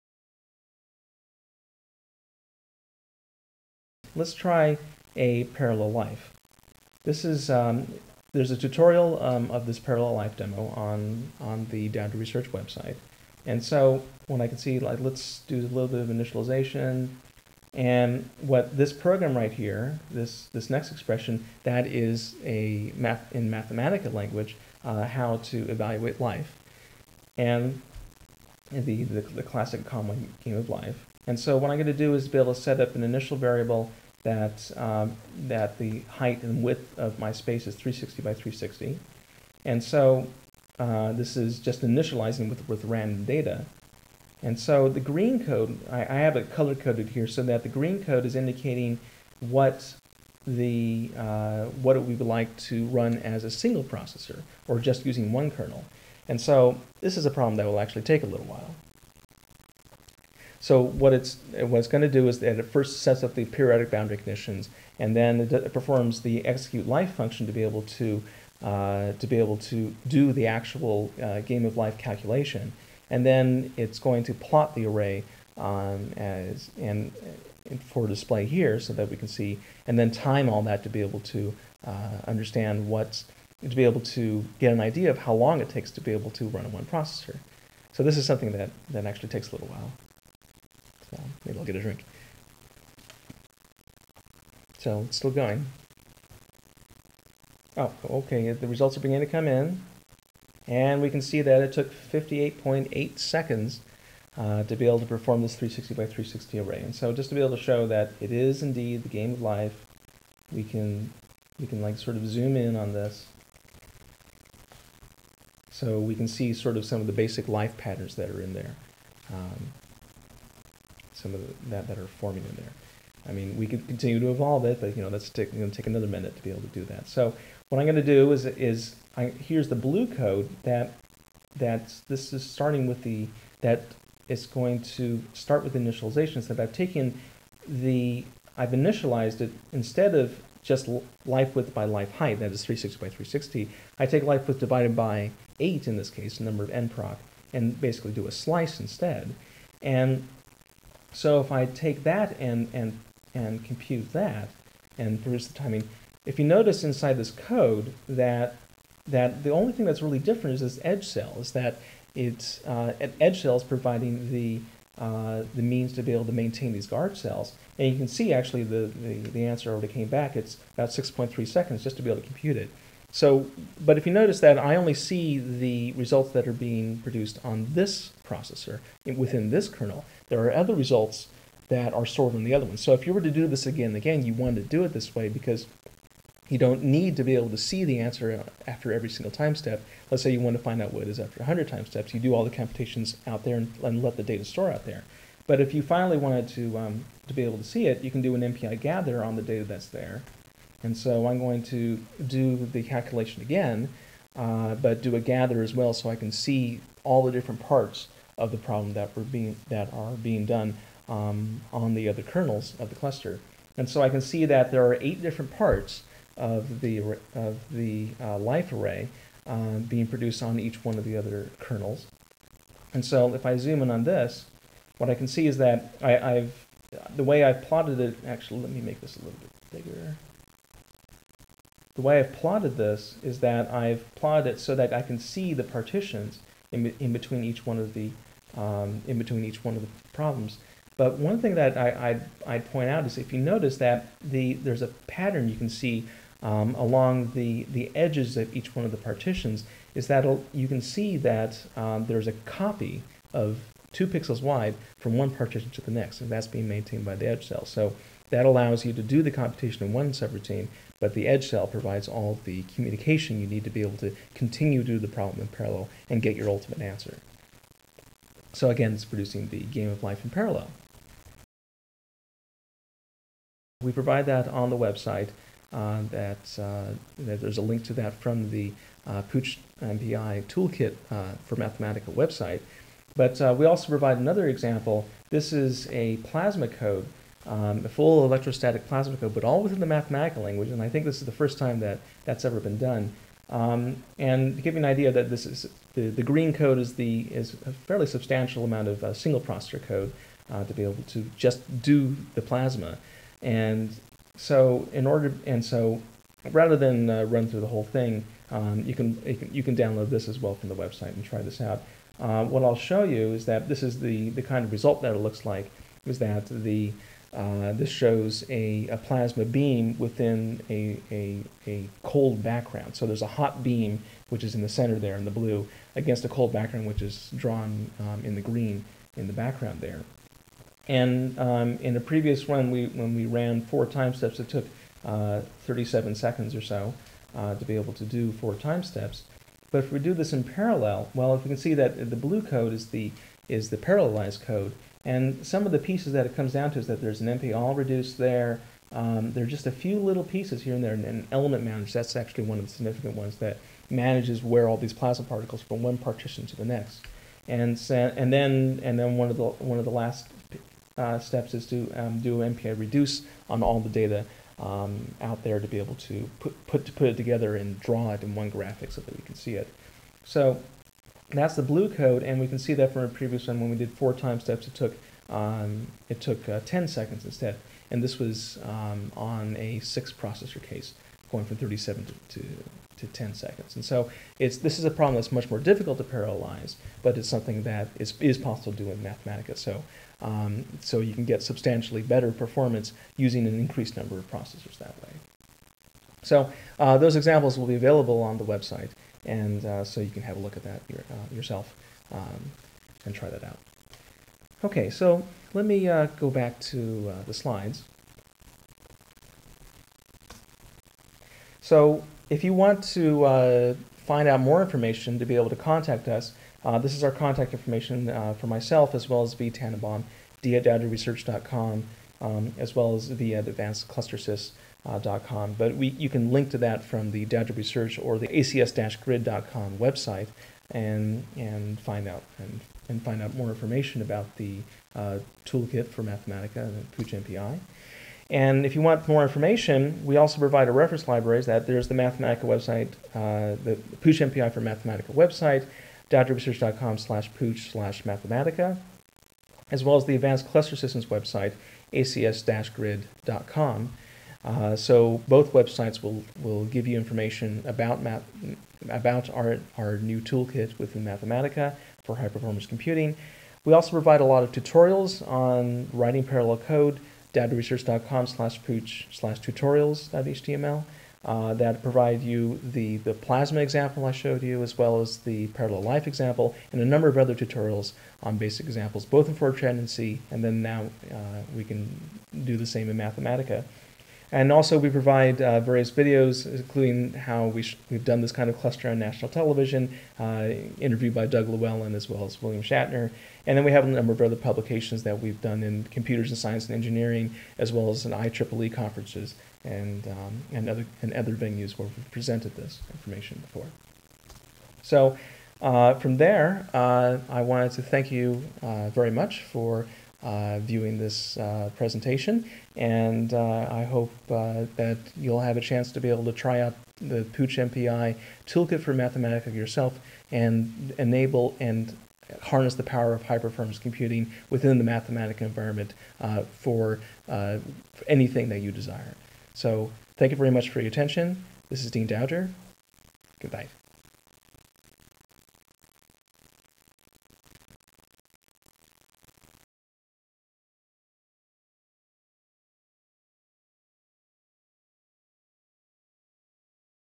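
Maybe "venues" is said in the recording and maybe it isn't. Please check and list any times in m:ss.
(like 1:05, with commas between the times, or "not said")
8:21.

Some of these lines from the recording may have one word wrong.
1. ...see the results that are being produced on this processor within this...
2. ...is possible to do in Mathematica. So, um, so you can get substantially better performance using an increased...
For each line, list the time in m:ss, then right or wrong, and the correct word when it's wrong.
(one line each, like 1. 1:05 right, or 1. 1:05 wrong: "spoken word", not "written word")
1. 2:54 right
2. 6:28 right.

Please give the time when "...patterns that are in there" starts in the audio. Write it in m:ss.
1:57.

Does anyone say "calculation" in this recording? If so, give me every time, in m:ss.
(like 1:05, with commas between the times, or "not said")
1:11, 3:22.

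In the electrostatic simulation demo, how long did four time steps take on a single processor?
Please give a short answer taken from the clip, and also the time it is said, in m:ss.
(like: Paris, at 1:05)
37 seconds, at 5:35.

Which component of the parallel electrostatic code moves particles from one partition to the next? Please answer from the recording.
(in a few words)
element manager.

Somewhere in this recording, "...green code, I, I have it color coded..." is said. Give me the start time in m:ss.
0:44.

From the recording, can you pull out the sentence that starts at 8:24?
So, uh, from there, uh, I wanted to thank you uh, very much for.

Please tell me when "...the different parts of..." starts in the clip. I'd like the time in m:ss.
3:27.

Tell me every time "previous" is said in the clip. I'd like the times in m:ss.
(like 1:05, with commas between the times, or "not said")
5:32, 6:13.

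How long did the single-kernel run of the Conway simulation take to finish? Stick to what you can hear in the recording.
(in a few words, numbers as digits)
58.8 seconds.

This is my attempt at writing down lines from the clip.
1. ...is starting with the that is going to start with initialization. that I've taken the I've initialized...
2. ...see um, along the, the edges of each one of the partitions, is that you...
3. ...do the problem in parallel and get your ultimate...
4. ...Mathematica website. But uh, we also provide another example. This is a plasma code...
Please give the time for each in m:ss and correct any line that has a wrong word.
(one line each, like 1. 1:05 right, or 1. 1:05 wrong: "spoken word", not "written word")
1. 2:12 right
2. 4:05 right
3. 4:24 right
4. 4:41 right.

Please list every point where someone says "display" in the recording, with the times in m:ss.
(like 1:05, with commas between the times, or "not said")
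1:18.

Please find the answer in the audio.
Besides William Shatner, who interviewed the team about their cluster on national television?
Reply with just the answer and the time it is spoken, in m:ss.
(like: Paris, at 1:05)
Doug Llewellyn, at 8:11.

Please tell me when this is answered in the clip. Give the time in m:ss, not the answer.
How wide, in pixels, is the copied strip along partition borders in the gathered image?
4:13.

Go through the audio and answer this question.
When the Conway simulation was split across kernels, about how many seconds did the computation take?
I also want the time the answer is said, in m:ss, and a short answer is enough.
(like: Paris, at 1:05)
6.3 seconds, at 2:50.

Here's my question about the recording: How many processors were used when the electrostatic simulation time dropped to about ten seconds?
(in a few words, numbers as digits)
6.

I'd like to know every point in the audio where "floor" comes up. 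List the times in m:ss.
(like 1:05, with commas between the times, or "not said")
not said.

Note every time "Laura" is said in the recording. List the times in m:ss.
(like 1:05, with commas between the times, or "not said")
not said.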